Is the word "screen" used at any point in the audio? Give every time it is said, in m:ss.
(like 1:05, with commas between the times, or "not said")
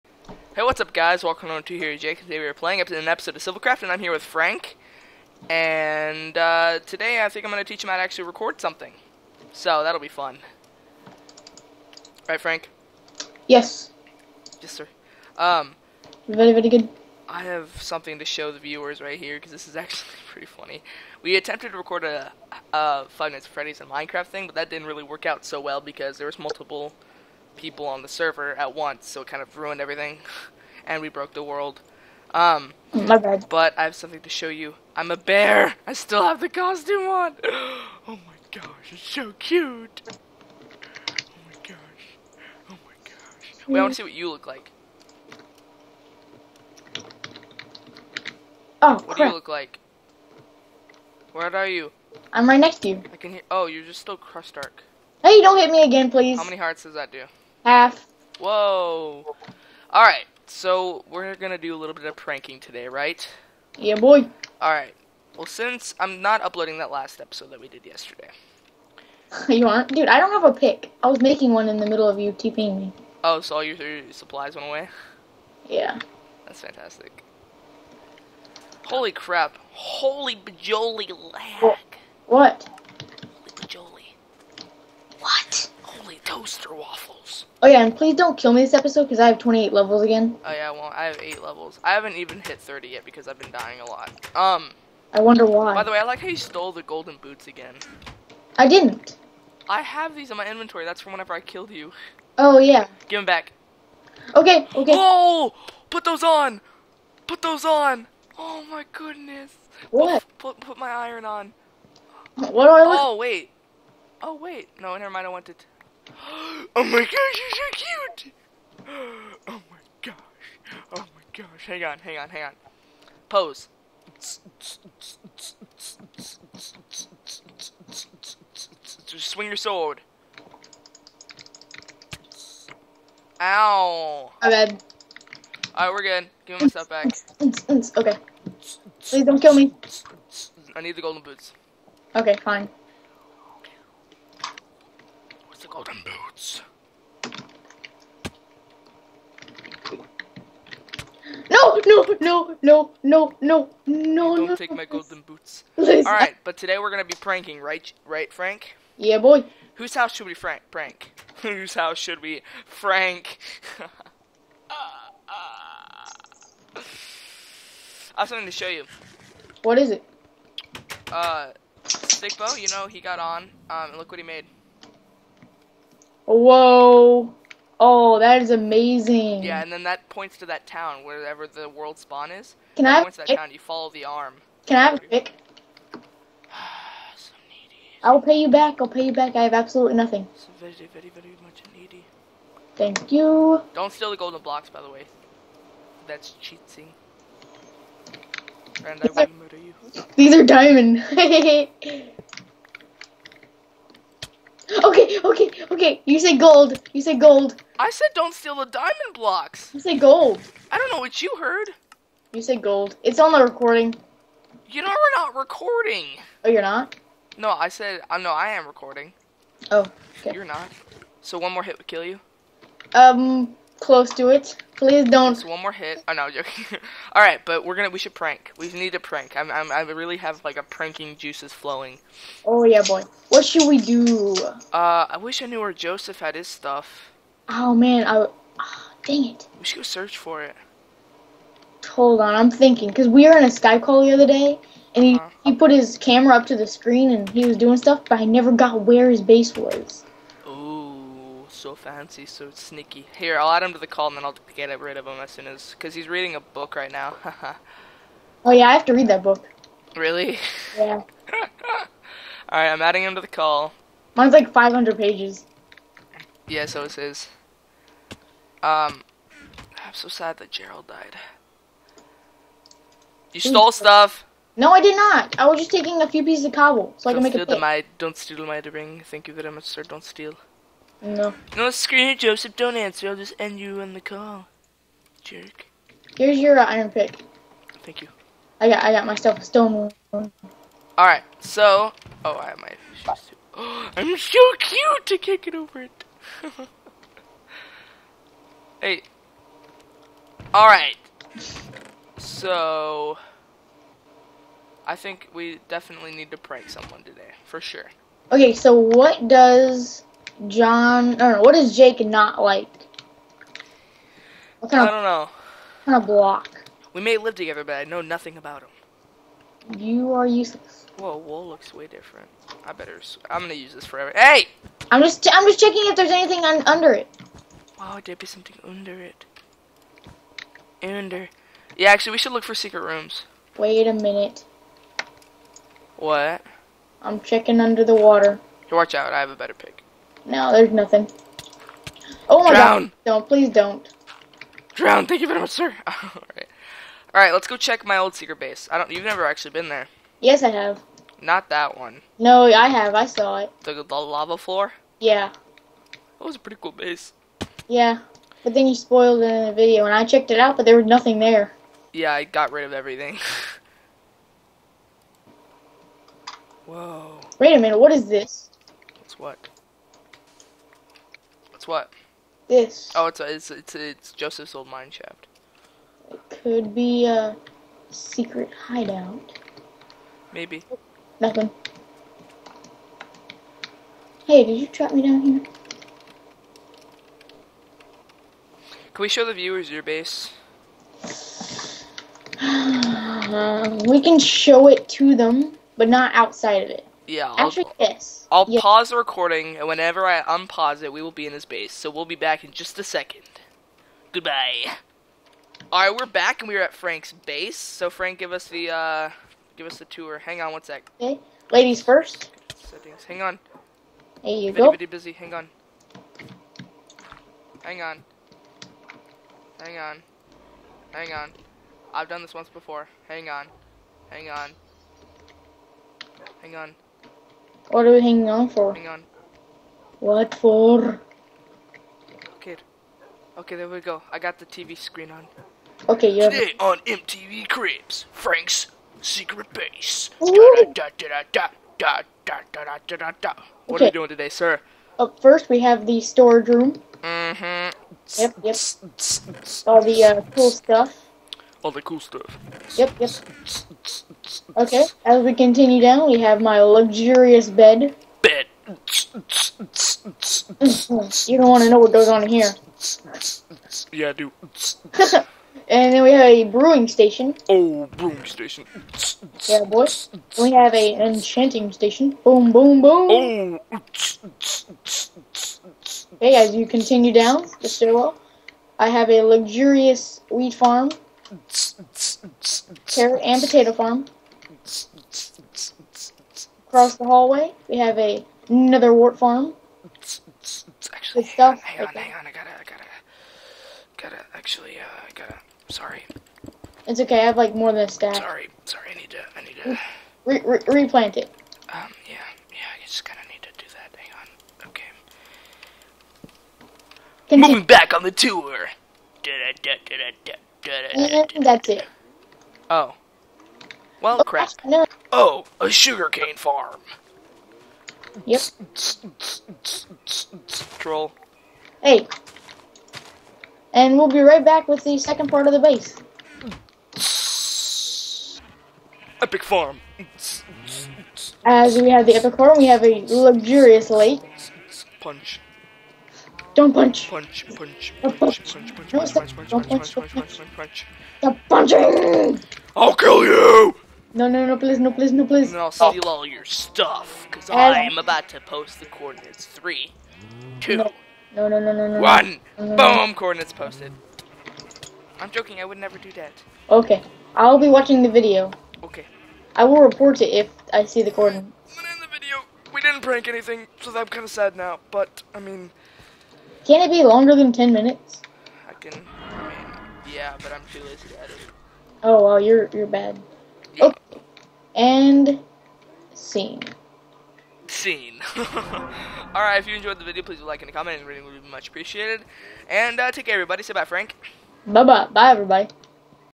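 4:06, 4:41, 7:14.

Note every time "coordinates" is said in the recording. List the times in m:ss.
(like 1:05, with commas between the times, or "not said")
9:08, 9:13, 9:21.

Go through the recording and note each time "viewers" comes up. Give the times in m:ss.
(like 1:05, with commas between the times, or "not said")
0:18, 6:29.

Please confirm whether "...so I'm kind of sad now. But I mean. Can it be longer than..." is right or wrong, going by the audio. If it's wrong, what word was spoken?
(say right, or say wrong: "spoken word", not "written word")
right.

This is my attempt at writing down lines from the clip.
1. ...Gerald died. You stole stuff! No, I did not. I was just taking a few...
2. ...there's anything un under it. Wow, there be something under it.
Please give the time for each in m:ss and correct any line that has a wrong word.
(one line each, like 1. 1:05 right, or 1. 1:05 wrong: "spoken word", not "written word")
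1. 4:30 right
2. 5:25 right.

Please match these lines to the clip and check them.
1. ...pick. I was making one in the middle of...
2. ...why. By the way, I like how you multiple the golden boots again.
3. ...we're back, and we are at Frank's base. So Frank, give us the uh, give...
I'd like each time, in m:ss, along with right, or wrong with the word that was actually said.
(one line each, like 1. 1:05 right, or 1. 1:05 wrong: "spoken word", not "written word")
1. 1:10 right
2. 1:35 wrong: "stole", not "multiple"
3. 6:45 right.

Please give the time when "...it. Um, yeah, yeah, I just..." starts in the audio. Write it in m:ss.
8:21.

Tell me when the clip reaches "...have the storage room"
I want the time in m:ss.
7:25.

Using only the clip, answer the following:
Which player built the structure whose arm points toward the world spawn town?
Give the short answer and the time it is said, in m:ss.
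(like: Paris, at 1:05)
Stickbo, at 2:51.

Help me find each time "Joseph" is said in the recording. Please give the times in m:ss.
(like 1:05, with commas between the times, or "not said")
3:55, 4:42, 6:14.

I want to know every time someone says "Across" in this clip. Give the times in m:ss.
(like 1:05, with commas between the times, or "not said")
8:06.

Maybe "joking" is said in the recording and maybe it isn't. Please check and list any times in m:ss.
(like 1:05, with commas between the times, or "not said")
3:46, 9:15.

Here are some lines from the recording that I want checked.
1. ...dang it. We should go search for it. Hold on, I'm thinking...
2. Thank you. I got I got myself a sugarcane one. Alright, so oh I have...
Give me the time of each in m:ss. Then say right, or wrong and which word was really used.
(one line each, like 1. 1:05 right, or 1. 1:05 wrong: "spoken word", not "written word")
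1. 3:59 right
2. 4:47 wrong: "stone", not "sugarcane".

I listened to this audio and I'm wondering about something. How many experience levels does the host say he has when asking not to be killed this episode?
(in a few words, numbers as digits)
28.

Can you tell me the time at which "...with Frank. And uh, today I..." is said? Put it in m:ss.
0:04.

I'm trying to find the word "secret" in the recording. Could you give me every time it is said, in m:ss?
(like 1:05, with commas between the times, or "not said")
5:32, 5:48, 6:17, 7:19.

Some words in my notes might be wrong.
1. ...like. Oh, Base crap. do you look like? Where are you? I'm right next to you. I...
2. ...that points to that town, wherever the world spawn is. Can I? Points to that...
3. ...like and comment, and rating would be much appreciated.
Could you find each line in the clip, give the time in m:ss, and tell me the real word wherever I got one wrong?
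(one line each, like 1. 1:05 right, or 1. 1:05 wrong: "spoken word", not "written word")
1. 0:44 wrong: "What", not "Base"
2. 2:59 right
3. 9:40 right.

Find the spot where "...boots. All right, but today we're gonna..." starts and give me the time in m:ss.
2:35.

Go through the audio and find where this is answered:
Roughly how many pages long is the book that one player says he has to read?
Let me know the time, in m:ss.
4:24.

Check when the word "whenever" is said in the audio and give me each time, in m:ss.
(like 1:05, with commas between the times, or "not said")
1:41, 6:39.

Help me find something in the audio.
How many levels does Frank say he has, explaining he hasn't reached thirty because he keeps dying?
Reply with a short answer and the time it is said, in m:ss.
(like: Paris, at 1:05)
8, at 1:31.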